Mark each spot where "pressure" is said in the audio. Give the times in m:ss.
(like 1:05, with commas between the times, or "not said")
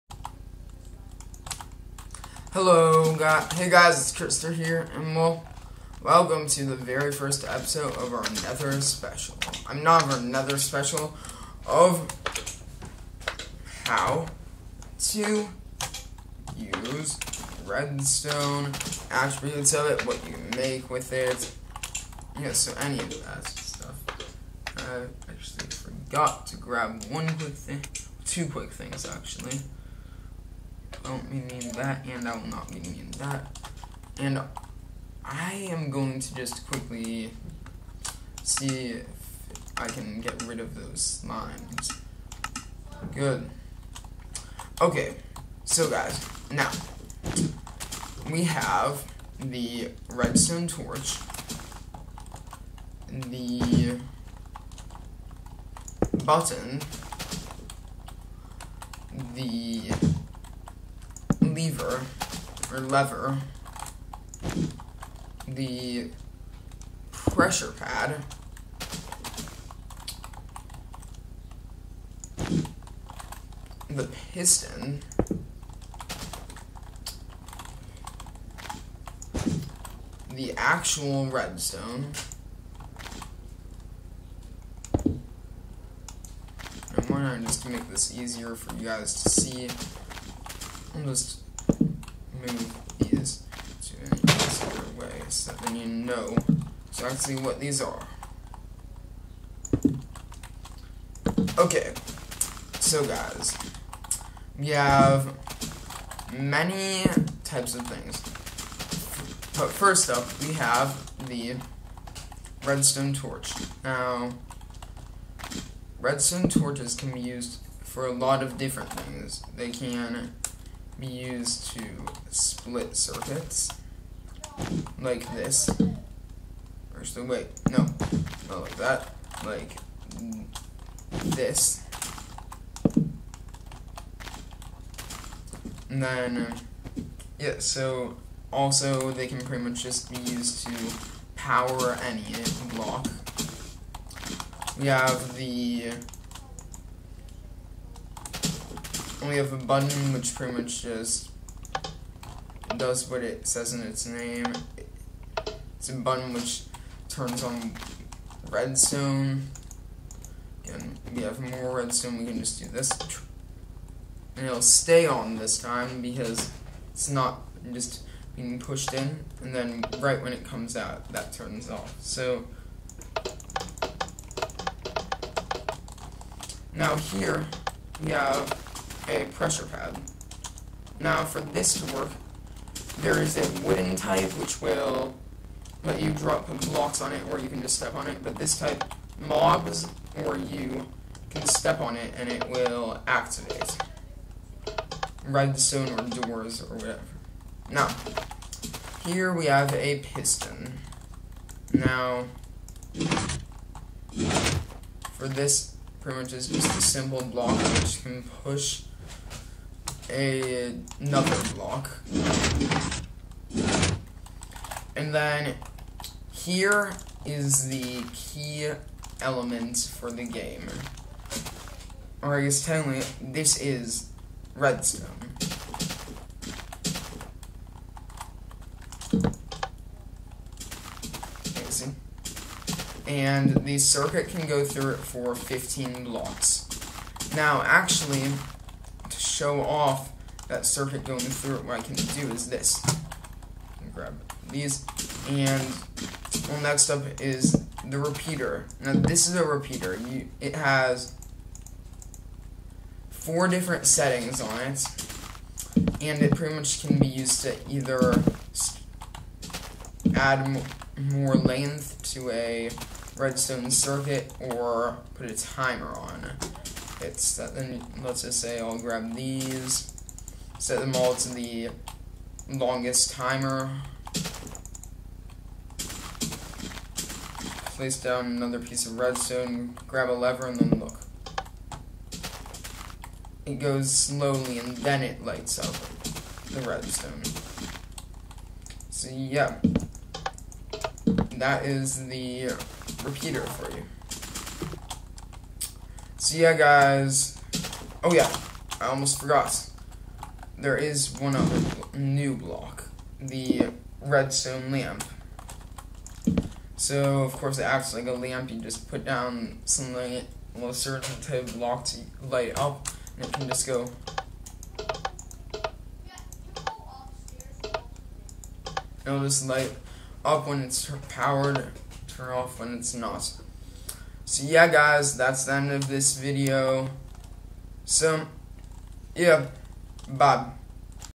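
1:07, 2:59.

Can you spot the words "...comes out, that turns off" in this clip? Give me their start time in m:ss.
2:50.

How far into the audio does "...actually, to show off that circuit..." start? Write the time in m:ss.
3:57.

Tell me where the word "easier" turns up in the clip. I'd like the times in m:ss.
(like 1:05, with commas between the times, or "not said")
1:28.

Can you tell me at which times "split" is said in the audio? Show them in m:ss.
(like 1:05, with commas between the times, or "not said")
2:02.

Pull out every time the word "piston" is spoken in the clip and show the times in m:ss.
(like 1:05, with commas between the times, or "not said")
1:14, 3:19.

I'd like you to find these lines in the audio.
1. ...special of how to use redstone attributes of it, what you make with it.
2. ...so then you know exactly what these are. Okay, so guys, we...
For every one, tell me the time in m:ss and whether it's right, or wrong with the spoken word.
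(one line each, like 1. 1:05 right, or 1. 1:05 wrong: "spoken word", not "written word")
1. 0:10 right
2. 1:35 right.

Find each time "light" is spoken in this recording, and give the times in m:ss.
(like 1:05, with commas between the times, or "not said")
4:45, 5:12, 5:19.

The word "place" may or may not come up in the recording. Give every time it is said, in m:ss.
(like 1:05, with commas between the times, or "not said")
4:37.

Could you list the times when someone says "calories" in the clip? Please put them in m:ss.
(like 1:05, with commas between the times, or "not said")
not said.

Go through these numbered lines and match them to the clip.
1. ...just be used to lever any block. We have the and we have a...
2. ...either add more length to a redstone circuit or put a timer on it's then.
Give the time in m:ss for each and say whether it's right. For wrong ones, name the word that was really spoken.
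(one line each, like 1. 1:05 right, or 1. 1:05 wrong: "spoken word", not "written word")
1. 2:19 wrong: "power", not "lever"
2. 4:17 right.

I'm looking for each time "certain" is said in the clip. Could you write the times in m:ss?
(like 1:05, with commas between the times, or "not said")
5:10.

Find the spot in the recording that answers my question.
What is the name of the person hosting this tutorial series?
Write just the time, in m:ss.
0:04.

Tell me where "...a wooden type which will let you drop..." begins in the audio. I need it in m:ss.
3:03.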